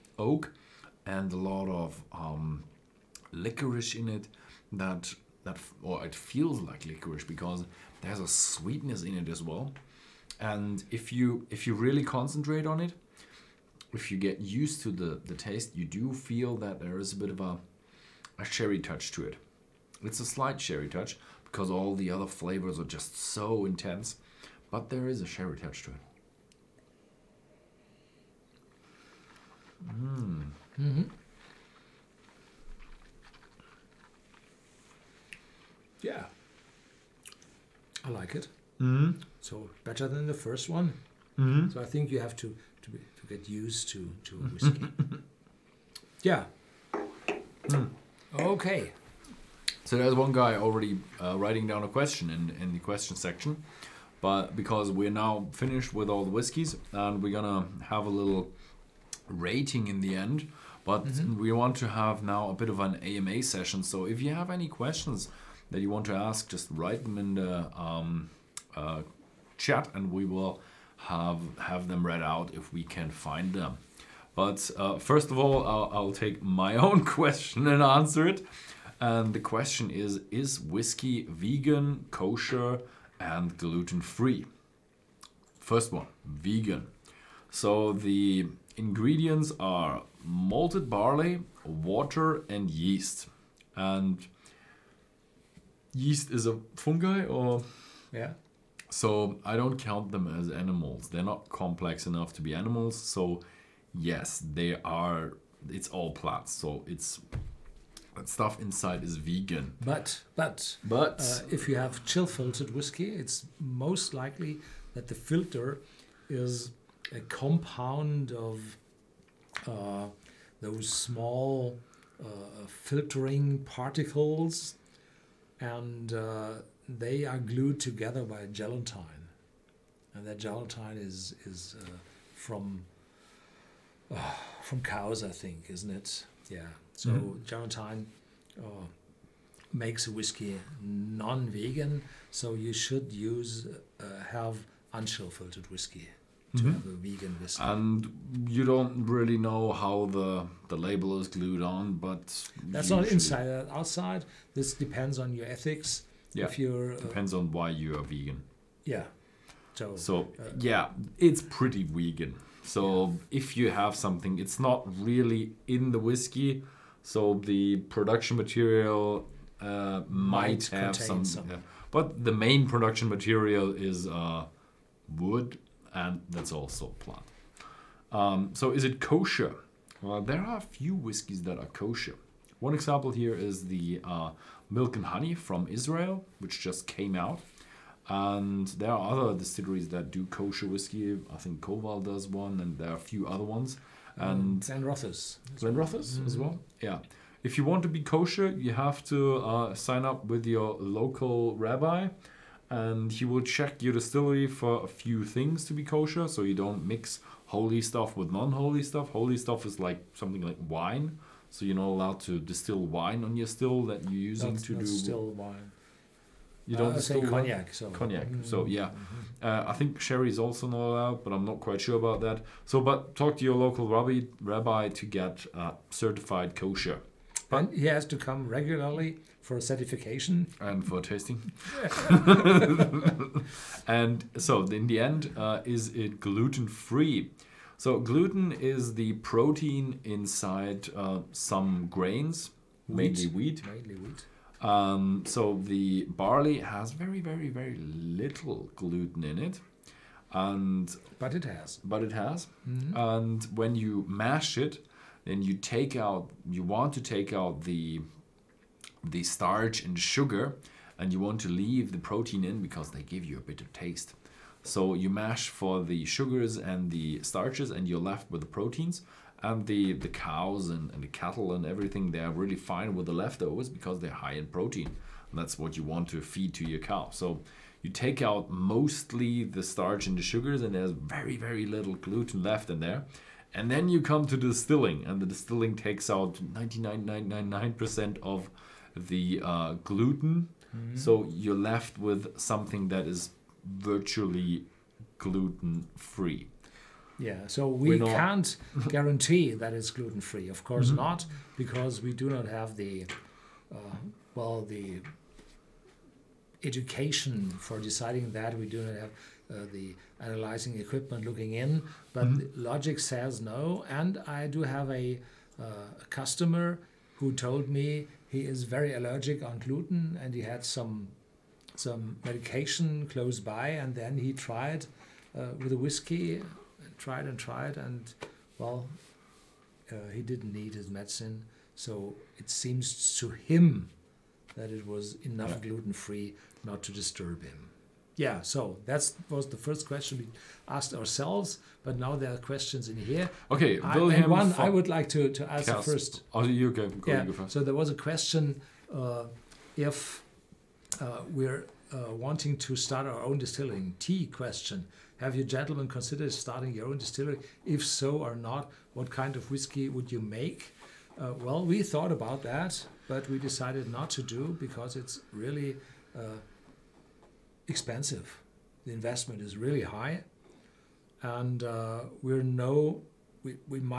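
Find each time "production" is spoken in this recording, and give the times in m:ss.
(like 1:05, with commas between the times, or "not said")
2:47, 2:52.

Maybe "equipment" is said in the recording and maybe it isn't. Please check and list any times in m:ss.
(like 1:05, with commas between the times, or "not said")
5:10.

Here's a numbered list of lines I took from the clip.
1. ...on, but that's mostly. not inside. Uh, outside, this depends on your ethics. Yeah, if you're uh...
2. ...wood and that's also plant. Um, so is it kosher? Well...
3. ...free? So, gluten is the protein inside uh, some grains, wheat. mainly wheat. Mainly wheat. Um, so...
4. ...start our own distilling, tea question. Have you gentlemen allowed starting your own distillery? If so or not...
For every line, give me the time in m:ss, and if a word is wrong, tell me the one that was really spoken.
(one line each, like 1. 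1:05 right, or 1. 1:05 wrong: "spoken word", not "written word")
1. 2:31 wrong: "usually", not "mostly"
2. 2:55 right
3. 3:56 right
4. 5:52 wrong: "considered", not "allowed".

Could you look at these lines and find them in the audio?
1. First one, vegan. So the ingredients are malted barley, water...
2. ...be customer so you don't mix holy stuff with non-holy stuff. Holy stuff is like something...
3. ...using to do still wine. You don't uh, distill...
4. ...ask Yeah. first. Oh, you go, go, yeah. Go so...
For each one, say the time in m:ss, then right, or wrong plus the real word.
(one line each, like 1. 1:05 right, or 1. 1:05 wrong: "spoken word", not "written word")
1. 1:25 right
2. 3:25 wrong: "kosher", not "customer"
3. 3:34 right
4. 5:45 wrong: "Kerst", not "Yeah".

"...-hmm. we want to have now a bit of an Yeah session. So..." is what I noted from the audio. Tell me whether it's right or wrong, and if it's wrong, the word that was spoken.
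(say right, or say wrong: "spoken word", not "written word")
wrong: "AMA", not "Yeah".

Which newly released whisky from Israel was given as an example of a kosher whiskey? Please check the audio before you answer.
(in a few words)
Milk and Honey.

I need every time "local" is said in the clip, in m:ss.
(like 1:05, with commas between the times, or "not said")
3:20, 3:43.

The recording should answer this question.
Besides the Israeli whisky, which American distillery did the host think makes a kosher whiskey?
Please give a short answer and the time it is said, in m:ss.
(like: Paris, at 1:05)
Koval, at 3:11.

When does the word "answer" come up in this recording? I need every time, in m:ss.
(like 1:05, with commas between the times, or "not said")
1:17.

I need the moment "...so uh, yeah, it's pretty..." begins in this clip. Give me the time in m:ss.
2:39.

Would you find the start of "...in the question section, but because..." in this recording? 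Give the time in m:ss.
0:52.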